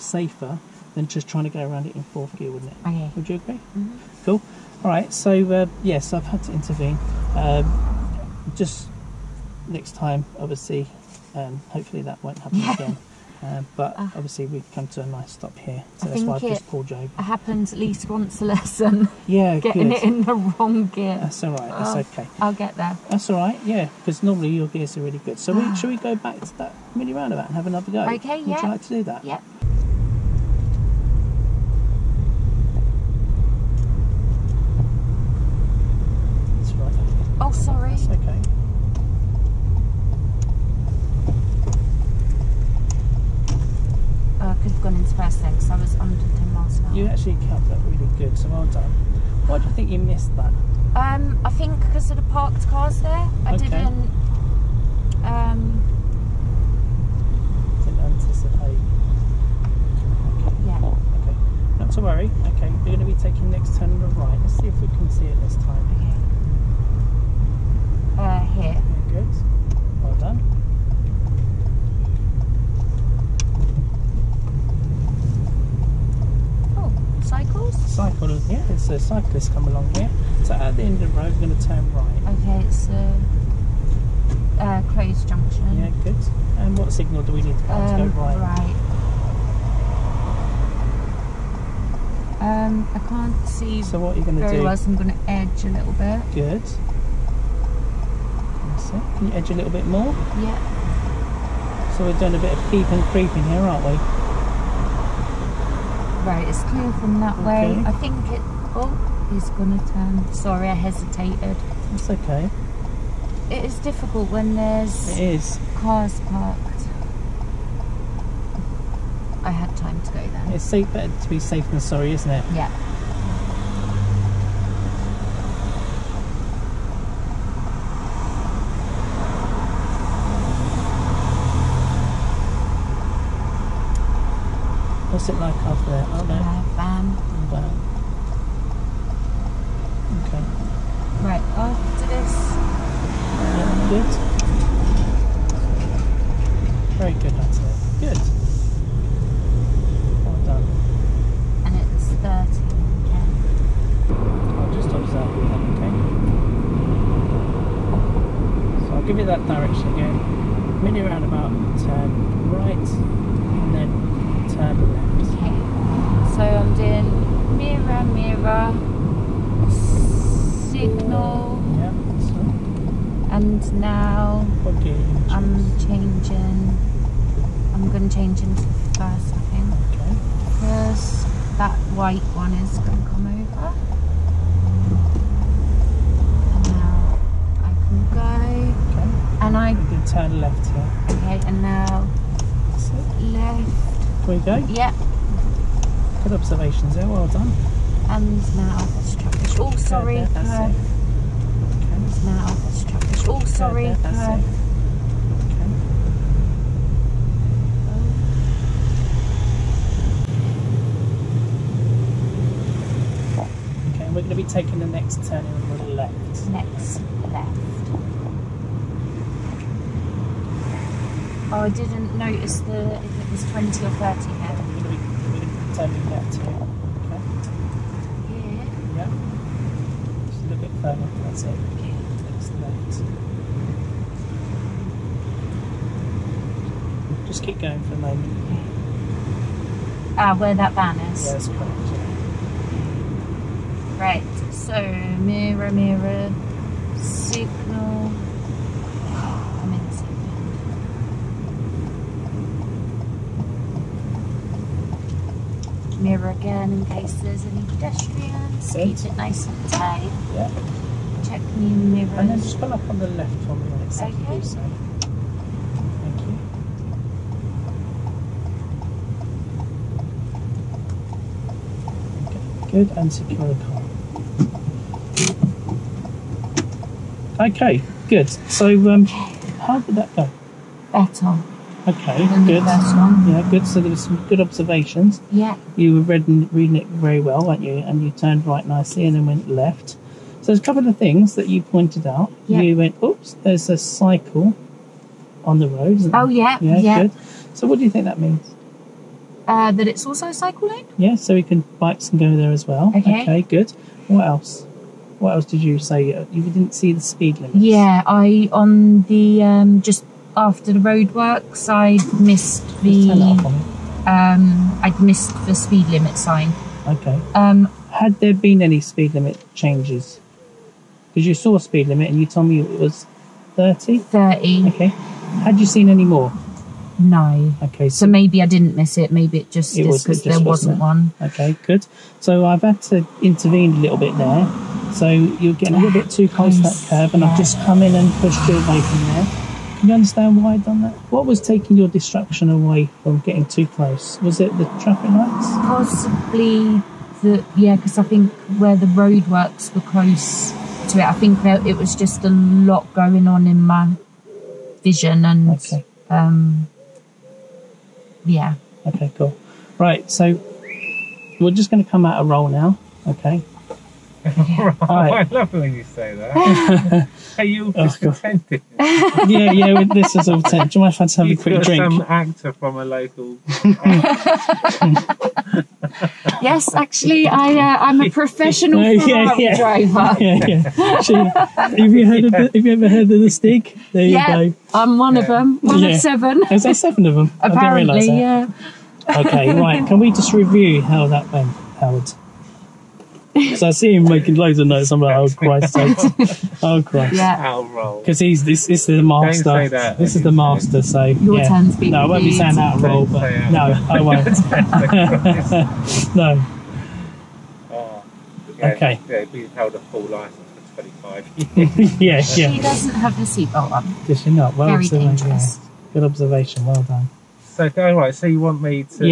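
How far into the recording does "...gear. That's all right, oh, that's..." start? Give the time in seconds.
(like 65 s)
20 s.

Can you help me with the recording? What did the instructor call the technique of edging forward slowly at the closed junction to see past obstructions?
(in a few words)
peep and creeping.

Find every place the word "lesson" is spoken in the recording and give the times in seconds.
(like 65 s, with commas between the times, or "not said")
18 s.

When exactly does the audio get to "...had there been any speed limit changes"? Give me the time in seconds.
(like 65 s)
317 s.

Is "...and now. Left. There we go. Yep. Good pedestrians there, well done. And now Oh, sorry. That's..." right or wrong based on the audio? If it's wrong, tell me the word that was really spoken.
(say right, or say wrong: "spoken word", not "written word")
wrong: "observations", not "pedestrians".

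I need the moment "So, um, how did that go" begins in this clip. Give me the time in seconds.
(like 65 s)
278 s.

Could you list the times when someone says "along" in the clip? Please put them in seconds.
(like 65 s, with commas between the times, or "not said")
79 s.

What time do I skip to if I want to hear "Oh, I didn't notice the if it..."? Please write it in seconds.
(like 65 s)
221 s.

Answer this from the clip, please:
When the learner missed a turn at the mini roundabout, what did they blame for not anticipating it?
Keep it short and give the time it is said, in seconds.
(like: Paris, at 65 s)
parked cars, at 52 s.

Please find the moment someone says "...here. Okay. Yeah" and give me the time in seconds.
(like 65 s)
226 s.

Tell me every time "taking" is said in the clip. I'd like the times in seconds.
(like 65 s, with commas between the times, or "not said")
63 s, 214 s, 341 s.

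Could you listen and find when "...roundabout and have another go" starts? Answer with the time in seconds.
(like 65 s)
27 s.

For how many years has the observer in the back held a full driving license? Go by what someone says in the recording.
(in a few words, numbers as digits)
25.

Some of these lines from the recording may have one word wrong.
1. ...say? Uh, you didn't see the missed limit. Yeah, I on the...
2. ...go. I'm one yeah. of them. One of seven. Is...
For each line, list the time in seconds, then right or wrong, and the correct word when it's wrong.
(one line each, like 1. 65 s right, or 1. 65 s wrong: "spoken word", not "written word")
1. 305 s wrong: "speed", not "missed"
2. 384 s right.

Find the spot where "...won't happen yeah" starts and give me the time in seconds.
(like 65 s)
12 s.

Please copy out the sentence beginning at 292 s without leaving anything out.
You went, oops, there's a cycle on the road.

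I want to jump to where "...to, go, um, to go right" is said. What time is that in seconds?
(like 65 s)
87 s.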